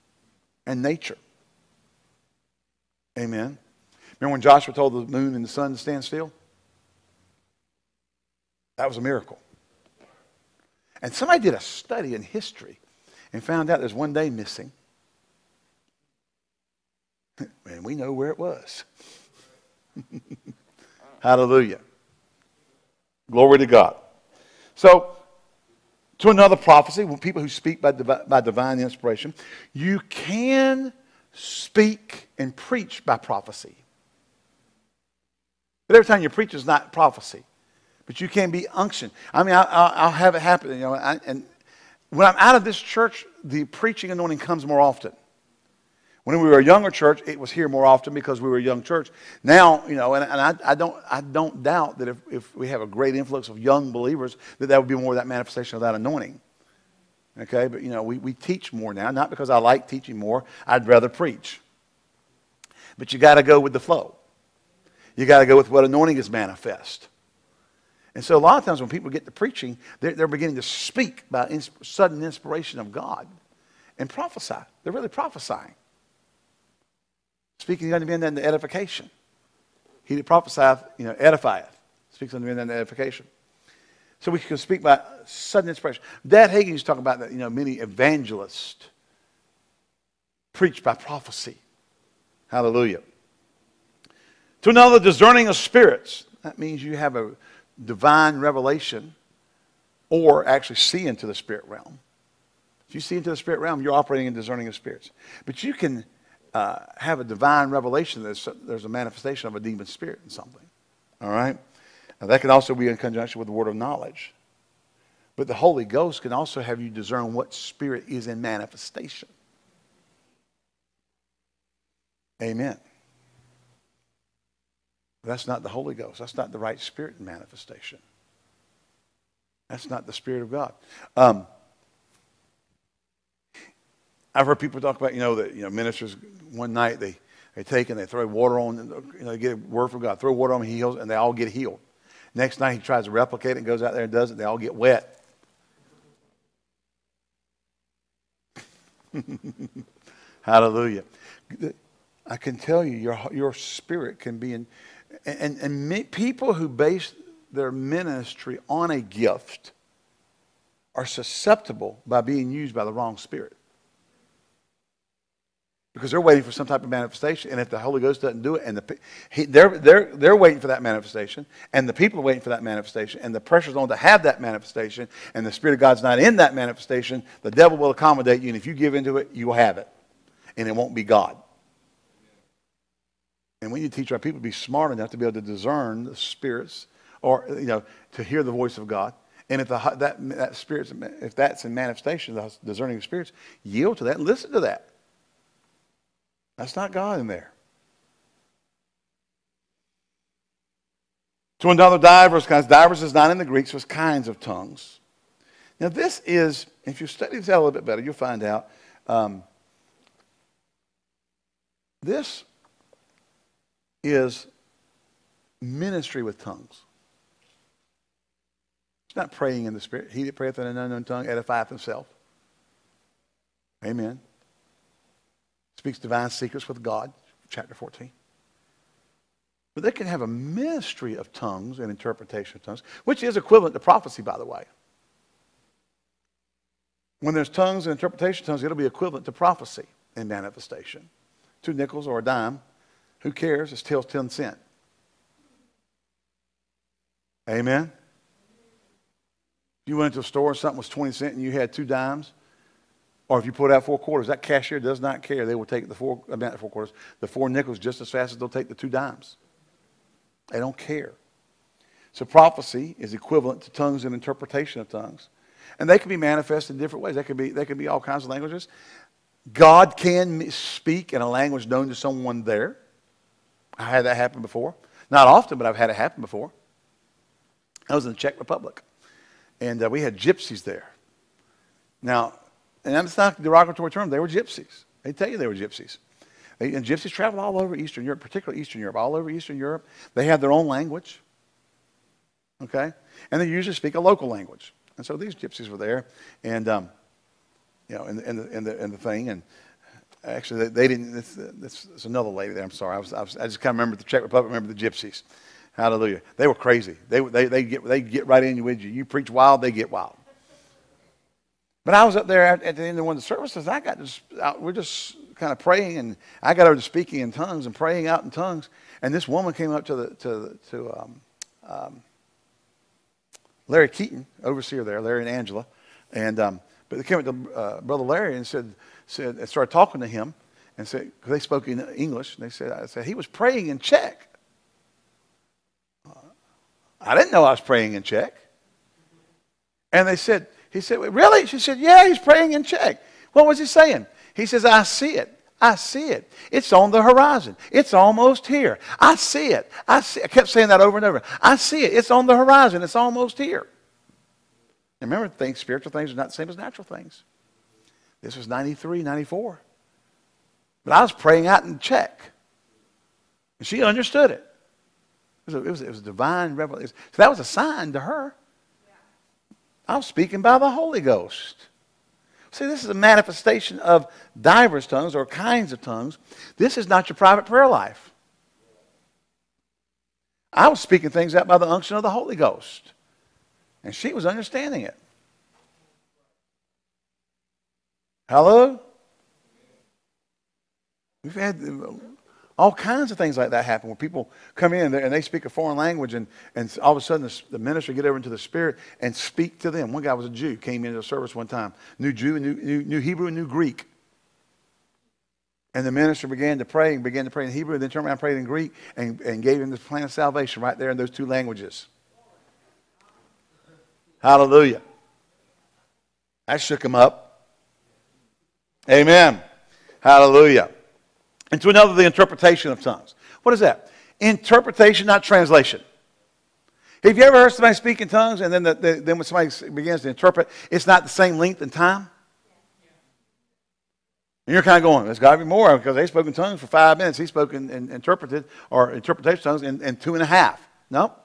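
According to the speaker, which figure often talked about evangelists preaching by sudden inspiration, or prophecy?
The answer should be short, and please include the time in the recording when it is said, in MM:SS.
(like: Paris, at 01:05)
Dad Hagin, at 01:26.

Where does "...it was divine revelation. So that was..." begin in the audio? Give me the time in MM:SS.
06:05.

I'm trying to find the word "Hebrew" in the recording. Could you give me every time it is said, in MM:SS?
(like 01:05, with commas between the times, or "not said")
06:42, 06:47.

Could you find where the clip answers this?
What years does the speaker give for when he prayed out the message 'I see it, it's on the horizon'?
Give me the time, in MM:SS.
05:58.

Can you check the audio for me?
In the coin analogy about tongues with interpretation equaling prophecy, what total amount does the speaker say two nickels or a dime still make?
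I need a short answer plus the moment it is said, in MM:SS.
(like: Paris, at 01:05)
10 cents, at 04:04.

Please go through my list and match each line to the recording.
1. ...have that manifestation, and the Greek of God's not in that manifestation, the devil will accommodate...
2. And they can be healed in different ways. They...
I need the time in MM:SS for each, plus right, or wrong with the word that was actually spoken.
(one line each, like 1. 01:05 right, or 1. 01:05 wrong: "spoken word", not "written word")
1. 02:53 wrong: "Spirit", not "Greek"
2. 04:25 wrong: "manifested", not "healed".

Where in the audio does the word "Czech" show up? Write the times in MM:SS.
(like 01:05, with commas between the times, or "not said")
04:38, 05:04, 05:33, 05:38, 05:42, 06:01.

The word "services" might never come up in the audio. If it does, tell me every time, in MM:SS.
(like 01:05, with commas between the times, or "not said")
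05:13, 06:41.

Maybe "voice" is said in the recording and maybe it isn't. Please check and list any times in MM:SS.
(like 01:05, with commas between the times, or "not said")
03:08.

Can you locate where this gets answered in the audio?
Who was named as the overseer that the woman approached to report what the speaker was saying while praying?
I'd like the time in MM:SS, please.
05:23.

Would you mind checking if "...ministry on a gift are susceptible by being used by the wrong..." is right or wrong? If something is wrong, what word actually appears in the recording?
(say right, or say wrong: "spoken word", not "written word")
right.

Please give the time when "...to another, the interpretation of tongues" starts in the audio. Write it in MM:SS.
07:01.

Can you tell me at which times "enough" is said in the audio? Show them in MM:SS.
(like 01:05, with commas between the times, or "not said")
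03:04.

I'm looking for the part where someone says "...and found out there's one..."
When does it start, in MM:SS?
00:13.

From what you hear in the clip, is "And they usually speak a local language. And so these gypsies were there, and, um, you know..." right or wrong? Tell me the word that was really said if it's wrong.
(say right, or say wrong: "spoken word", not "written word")
right.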